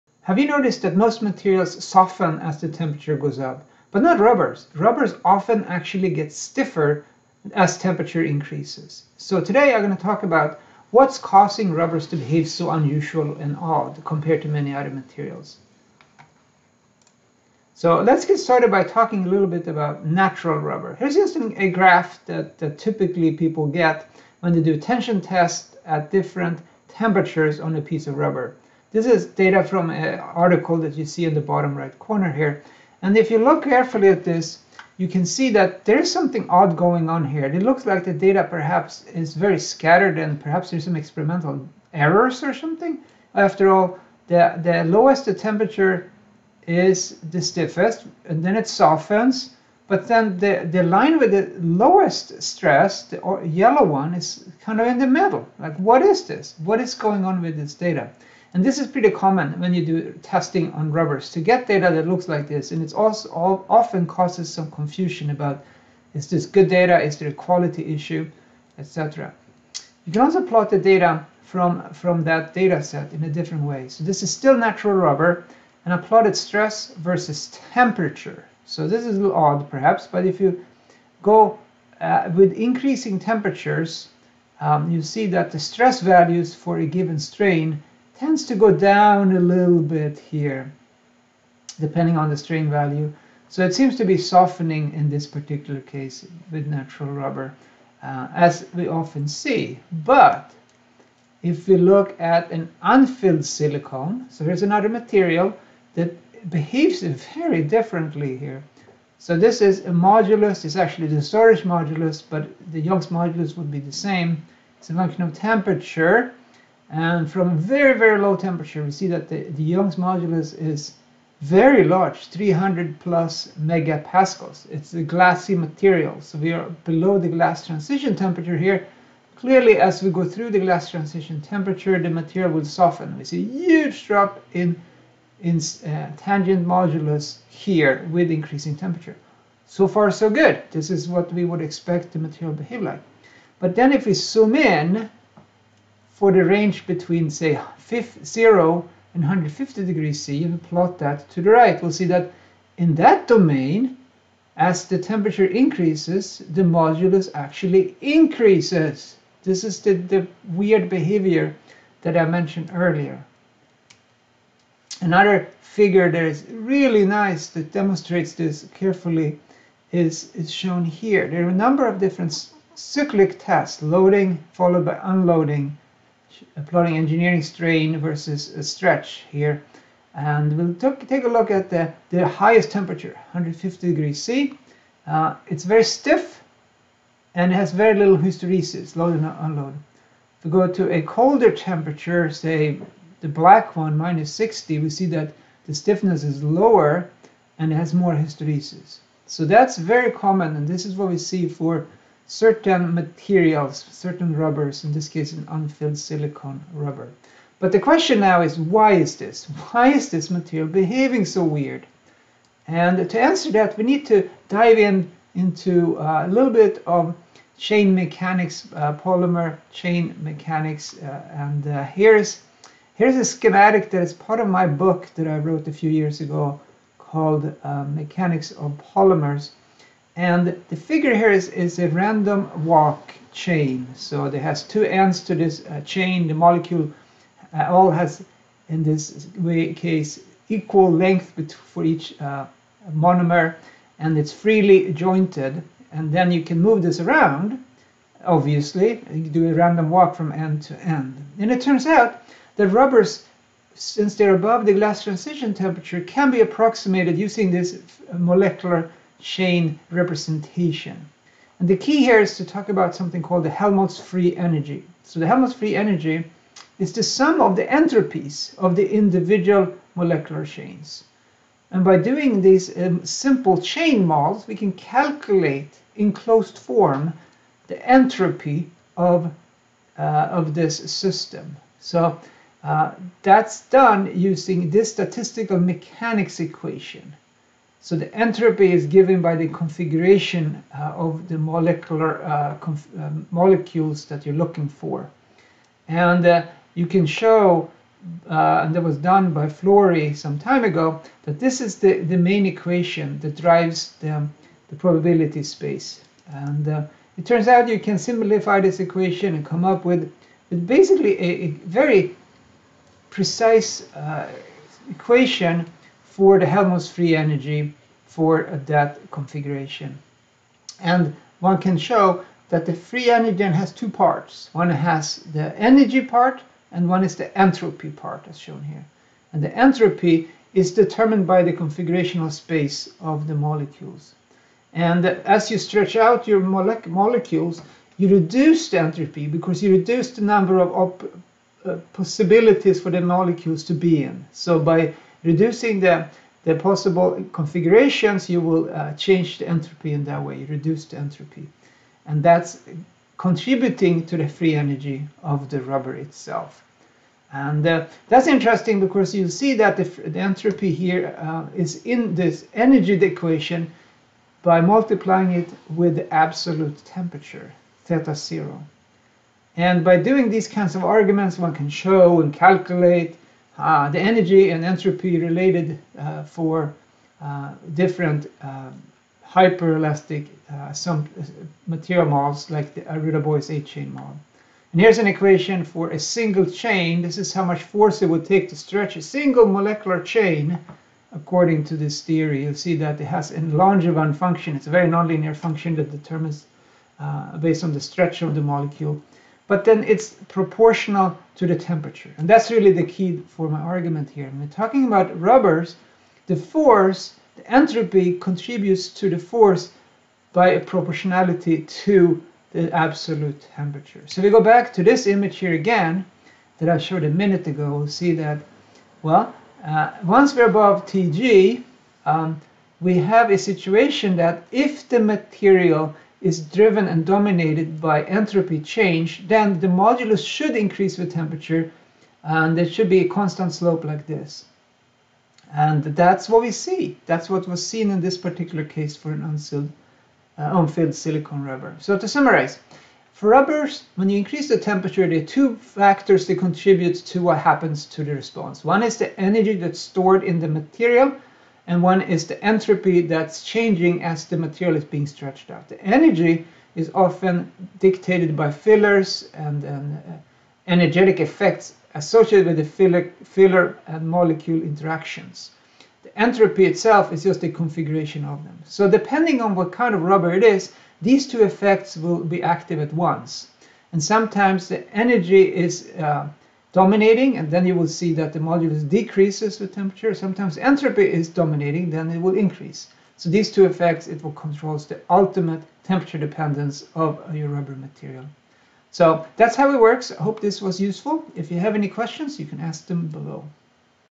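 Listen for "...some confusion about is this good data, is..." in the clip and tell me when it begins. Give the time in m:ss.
1:04.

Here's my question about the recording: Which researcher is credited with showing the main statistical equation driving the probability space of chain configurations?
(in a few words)
Flory.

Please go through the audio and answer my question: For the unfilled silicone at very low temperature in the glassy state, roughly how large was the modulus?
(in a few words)
300 plus megapascals.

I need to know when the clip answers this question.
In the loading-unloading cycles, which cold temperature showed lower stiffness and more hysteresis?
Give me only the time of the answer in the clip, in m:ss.
3:13.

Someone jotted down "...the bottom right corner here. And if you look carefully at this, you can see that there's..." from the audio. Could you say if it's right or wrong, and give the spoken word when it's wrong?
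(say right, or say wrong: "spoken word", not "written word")
right.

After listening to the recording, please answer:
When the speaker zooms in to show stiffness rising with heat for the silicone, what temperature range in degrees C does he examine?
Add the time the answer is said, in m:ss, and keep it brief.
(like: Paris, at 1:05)
0 to 150, at 2:26.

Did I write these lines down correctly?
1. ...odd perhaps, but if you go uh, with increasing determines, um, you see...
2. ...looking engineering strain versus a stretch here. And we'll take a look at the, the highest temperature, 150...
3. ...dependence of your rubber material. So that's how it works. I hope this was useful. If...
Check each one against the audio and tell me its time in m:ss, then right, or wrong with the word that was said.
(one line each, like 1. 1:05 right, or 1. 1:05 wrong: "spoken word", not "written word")
1. 1:19 wrong: "temperatures", not "determines"
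2. 2:56 wrong: "plotting", not "looking"
3. 8:06 right.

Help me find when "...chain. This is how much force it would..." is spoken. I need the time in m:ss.
6:26.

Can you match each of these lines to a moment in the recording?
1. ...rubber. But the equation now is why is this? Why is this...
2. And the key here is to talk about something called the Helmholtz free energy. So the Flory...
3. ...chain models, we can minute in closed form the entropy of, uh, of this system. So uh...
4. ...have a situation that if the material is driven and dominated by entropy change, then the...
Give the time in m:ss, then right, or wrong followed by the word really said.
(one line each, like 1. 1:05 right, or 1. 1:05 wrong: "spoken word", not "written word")
1. 3:26 wrong: "question", not "equation"
2. 4:21 wrong: "Helmholtz", not "Flory"
3. 4:33 wrong: "calculate", not "minute"
4. 7:02 right.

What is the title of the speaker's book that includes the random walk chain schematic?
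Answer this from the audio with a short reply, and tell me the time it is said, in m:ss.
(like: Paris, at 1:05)
Mechanics of Polymers, at 3:47.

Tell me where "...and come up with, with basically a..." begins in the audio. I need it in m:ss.
5:09.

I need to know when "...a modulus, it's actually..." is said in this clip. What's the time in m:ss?
1:49.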